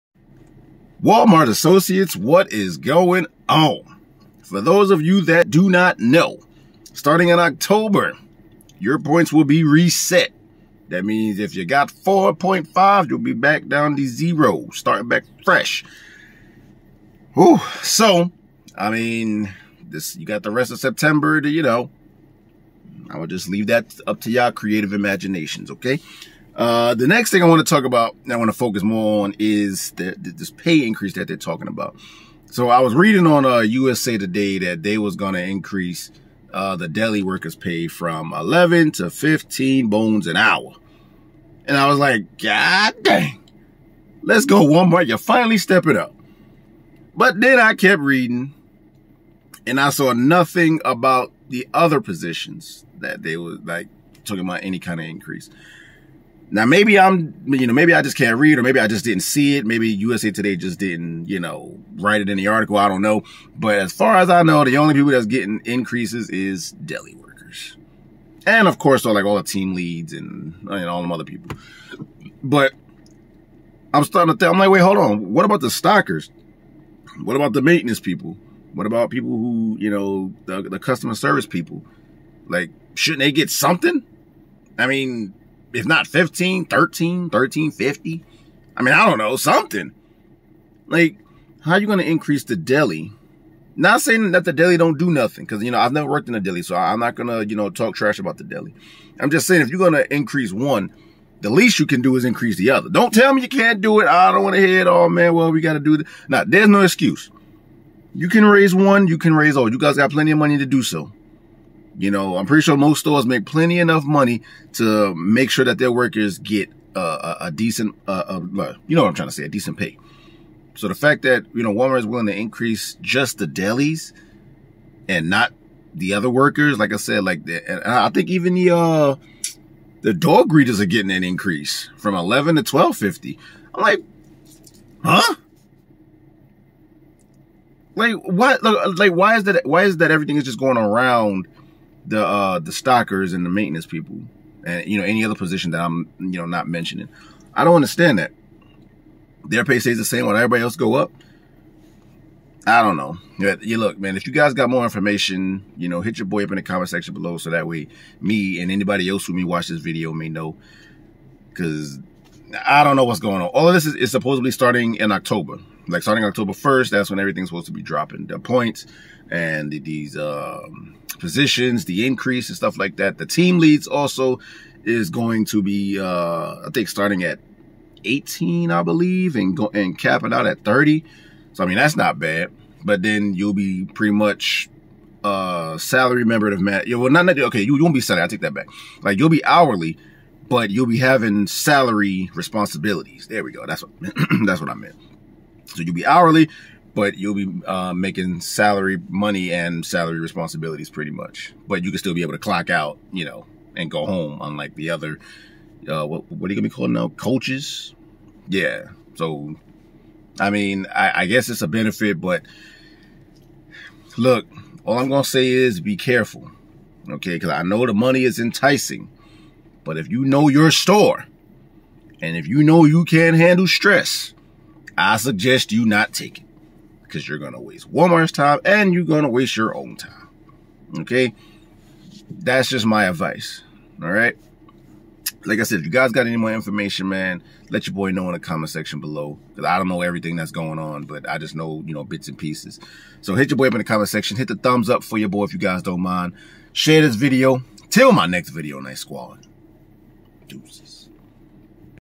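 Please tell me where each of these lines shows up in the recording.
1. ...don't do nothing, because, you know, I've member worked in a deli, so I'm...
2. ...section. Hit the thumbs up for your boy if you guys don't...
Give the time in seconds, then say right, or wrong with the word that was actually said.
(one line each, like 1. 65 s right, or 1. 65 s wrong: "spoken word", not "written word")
1. 94 s wrong: "never", not "member"
2. 244 s right.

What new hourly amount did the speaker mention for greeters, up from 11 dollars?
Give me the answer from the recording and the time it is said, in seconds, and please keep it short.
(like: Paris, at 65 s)
12.50, at 132 s.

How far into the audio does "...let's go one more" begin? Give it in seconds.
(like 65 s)
44 s.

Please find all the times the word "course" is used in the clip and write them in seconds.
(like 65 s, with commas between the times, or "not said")
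68 s.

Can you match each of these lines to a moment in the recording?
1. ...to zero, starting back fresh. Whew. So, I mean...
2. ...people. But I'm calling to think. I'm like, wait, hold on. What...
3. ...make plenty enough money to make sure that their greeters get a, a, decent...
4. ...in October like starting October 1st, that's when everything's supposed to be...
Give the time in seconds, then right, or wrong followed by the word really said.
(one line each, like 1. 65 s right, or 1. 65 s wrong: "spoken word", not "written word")
1. 13 s right
2. 71 s wrong: "starting", not "calling"
3. 113 s wrong: "workers", not "greeters"
4. 164 s right.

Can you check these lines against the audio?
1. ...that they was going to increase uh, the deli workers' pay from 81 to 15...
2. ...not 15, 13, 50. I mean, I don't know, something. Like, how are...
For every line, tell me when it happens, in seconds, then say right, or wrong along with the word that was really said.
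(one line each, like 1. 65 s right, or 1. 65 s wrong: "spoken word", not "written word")
1. 34 s wrong: "11", not "81"
2. 85 s right.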